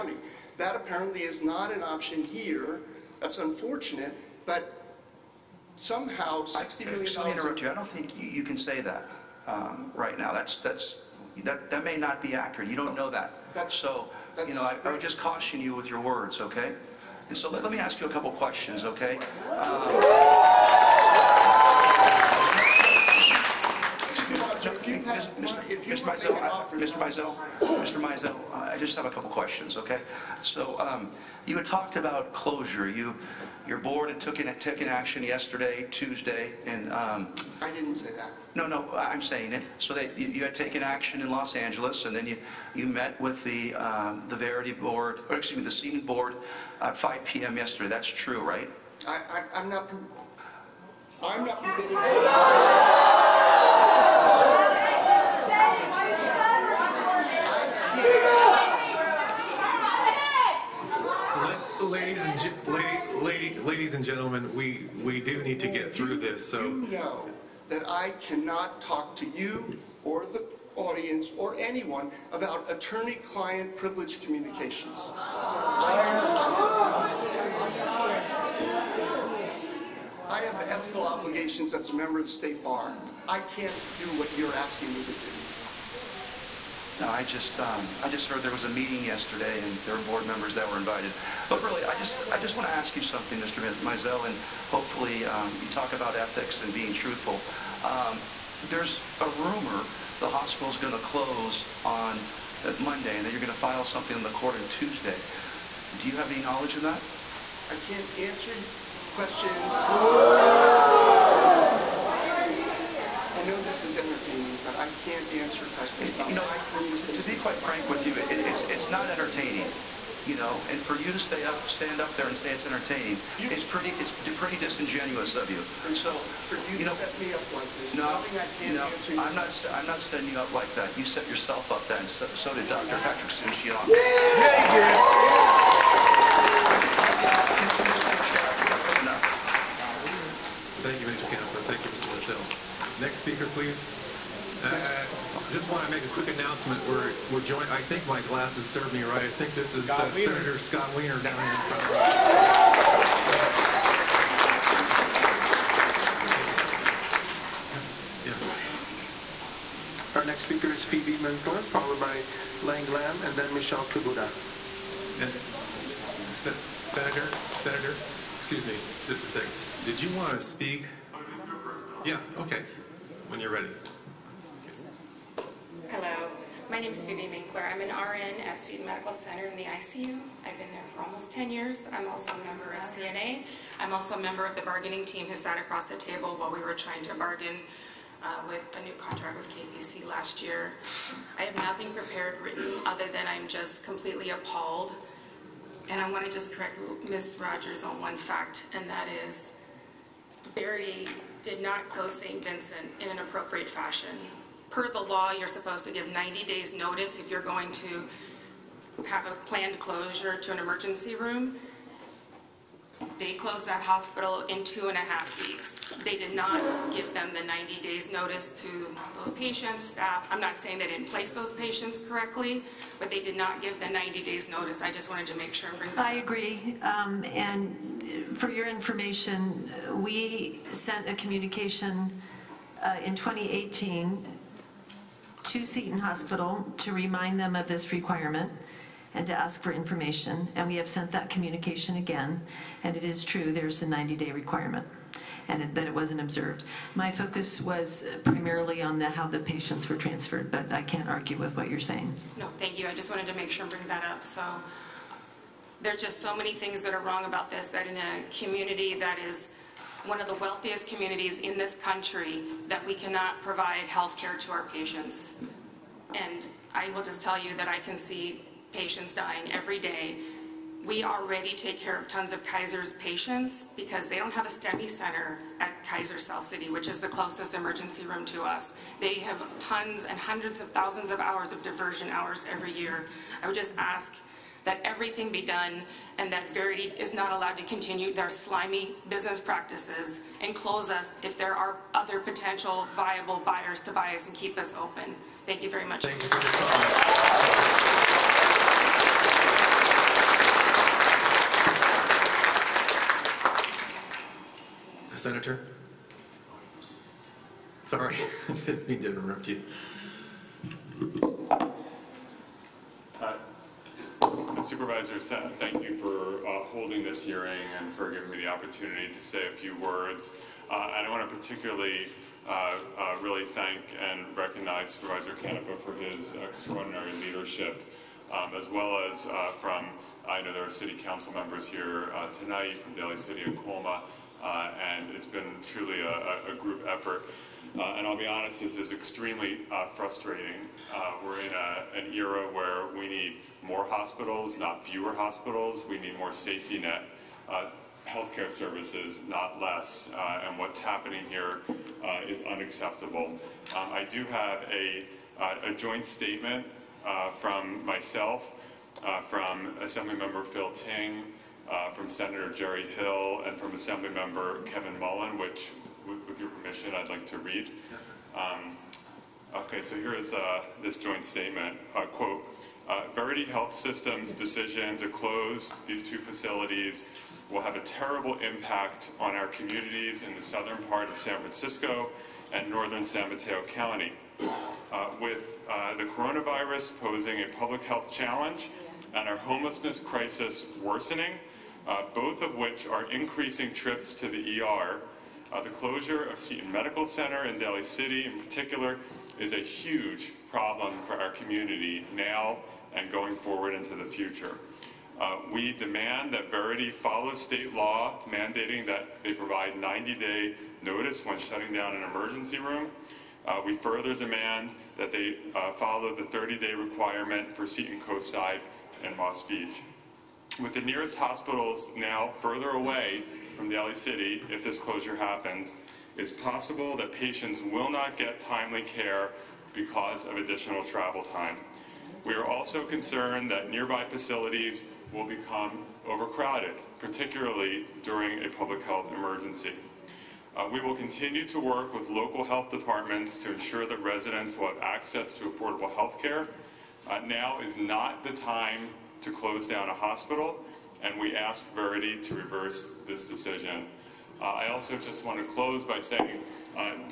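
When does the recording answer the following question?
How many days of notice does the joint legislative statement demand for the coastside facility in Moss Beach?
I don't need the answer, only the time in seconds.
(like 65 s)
416 s.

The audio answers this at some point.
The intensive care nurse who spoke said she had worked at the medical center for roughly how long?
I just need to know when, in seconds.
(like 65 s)
181 s.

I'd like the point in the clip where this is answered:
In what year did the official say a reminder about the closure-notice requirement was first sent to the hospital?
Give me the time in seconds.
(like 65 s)
233 s.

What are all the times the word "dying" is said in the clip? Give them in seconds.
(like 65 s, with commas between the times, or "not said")
269 s.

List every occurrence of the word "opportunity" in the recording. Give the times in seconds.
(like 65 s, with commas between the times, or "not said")
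318 s.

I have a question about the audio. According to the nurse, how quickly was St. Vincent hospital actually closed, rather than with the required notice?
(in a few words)
two and a half weeks.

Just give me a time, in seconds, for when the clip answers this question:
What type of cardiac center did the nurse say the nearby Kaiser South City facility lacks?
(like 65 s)
274 s.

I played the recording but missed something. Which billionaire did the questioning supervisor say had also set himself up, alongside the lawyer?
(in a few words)
Patrick Soon-Shiong.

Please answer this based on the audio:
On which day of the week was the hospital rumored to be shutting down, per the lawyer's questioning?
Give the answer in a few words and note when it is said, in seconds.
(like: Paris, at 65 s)
Monday, at 102 s.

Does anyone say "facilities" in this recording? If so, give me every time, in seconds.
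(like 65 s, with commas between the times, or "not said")
376 s, 434 s.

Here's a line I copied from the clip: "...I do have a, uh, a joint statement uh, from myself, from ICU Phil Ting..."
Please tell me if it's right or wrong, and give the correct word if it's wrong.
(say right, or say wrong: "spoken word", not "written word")
wrong: "Assemblymember", not "ICU".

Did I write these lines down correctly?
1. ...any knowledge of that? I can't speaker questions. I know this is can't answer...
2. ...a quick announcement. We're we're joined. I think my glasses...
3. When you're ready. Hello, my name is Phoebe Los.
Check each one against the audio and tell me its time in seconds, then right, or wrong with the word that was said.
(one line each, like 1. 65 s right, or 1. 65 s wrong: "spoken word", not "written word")
1. 106 s wrong: "answer", not "speaker"
2. 146 s right
3. 173 s wrong: "Minkler", not "Los".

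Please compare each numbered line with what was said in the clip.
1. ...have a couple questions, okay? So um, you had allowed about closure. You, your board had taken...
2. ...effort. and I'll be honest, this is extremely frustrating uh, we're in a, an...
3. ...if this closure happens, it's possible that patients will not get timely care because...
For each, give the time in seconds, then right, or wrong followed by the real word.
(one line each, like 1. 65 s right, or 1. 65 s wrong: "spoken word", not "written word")
1. 28 s wrong: "talked", not "allowed"
2. 336 s right
3. 424 s right.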